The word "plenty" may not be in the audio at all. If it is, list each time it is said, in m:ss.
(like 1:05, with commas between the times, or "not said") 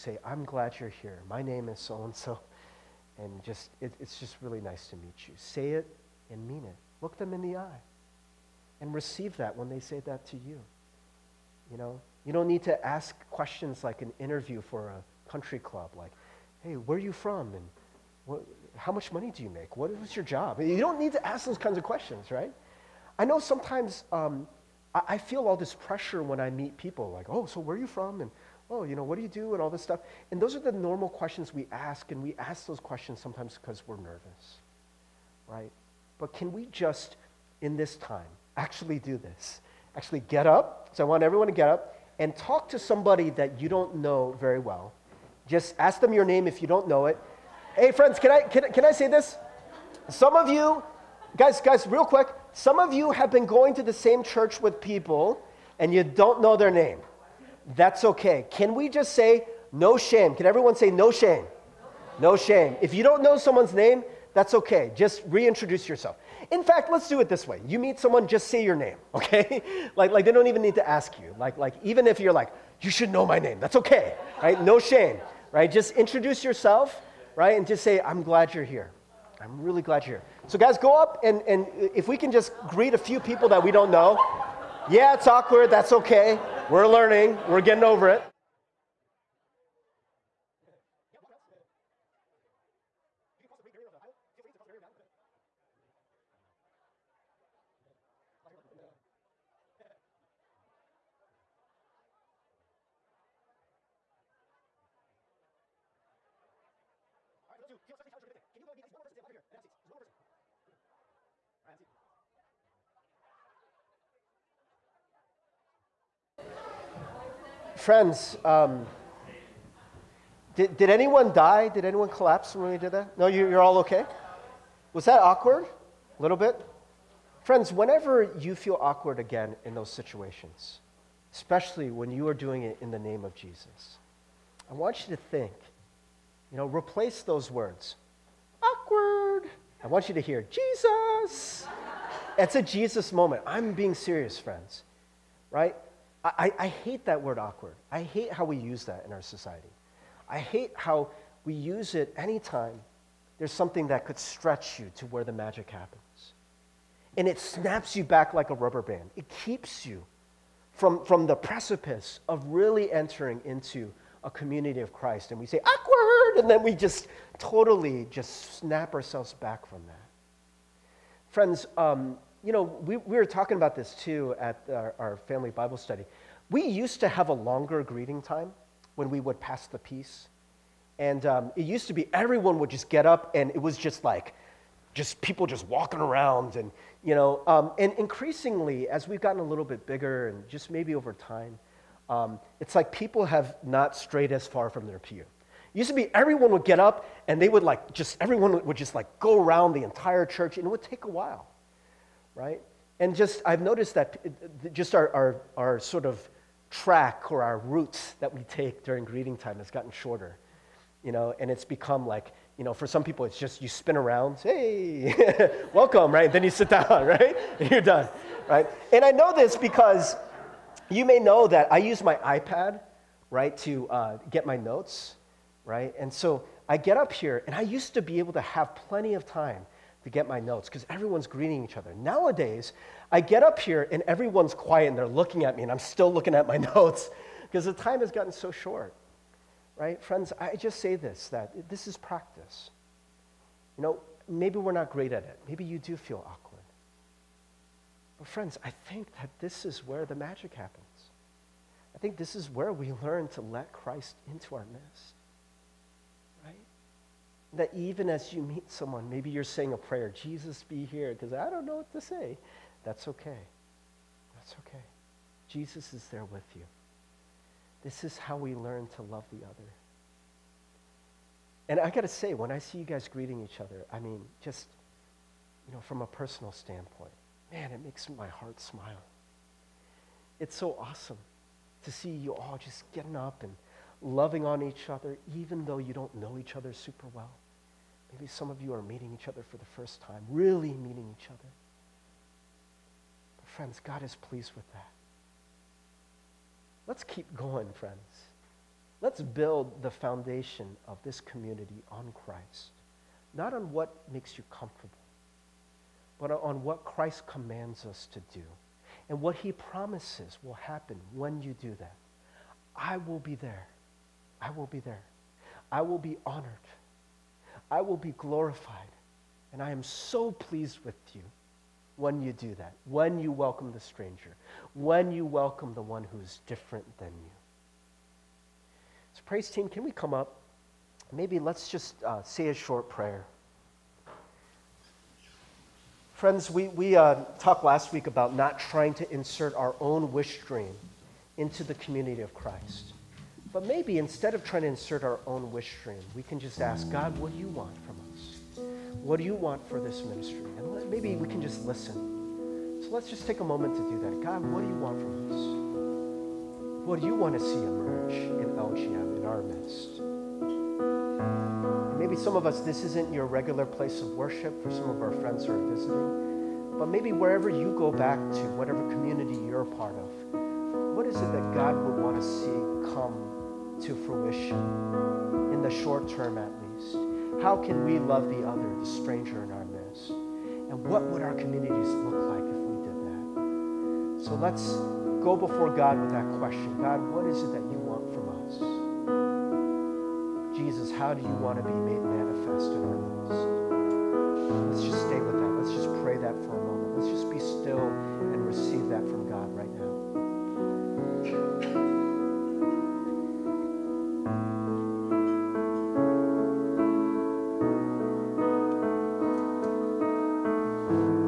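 3:48.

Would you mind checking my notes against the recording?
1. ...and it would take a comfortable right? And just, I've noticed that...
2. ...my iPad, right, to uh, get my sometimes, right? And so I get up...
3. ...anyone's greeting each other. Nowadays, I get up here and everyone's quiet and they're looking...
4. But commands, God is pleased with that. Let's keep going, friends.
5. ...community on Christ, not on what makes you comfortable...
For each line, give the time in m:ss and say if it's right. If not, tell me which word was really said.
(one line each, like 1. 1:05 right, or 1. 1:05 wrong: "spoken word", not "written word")
1. 3:20 wrong: "while", not "comfortable"
2. 3:42 wrong: "notes", not "sometimes"
3. 3:50 wrong: "everyone", not "anyone"
4. 4:53 wrong: "friends", not "commands"
5. 5:01 right.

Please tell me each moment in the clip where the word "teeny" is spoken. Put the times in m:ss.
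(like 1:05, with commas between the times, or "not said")
not said.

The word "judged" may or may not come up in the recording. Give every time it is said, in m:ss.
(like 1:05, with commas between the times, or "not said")
not said.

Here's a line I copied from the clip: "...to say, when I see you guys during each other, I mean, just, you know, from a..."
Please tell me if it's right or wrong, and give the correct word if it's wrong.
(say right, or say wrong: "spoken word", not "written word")
wrong: "greeting", not "during".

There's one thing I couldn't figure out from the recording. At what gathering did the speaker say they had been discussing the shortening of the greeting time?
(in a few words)
family Bible study.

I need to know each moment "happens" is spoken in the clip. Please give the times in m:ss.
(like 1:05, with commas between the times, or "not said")
2:35, 4:10, 5:10.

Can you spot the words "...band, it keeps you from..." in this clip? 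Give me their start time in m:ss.
2:38.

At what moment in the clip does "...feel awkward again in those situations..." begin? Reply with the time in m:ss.
2:08.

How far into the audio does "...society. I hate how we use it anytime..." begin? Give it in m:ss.
2:29.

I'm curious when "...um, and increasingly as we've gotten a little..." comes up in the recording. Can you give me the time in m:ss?
3:07.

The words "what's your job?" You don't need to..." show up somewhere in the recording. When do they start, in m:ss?
0:19.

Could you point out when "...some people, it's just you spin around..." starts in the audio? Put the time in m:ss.
3:32.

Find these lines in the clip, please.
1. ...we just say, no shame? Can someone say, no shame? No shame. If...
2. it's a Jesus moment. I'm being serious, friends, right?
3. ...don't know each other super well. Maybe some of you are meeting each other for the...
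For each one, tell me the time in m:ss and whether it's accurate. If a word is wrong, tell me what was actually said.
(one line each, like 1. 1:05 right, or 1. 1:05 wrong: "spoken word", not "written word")
1. 0:58 wrong: "everyone", not "someone"
2. 2:22 right
3. 4:45 right.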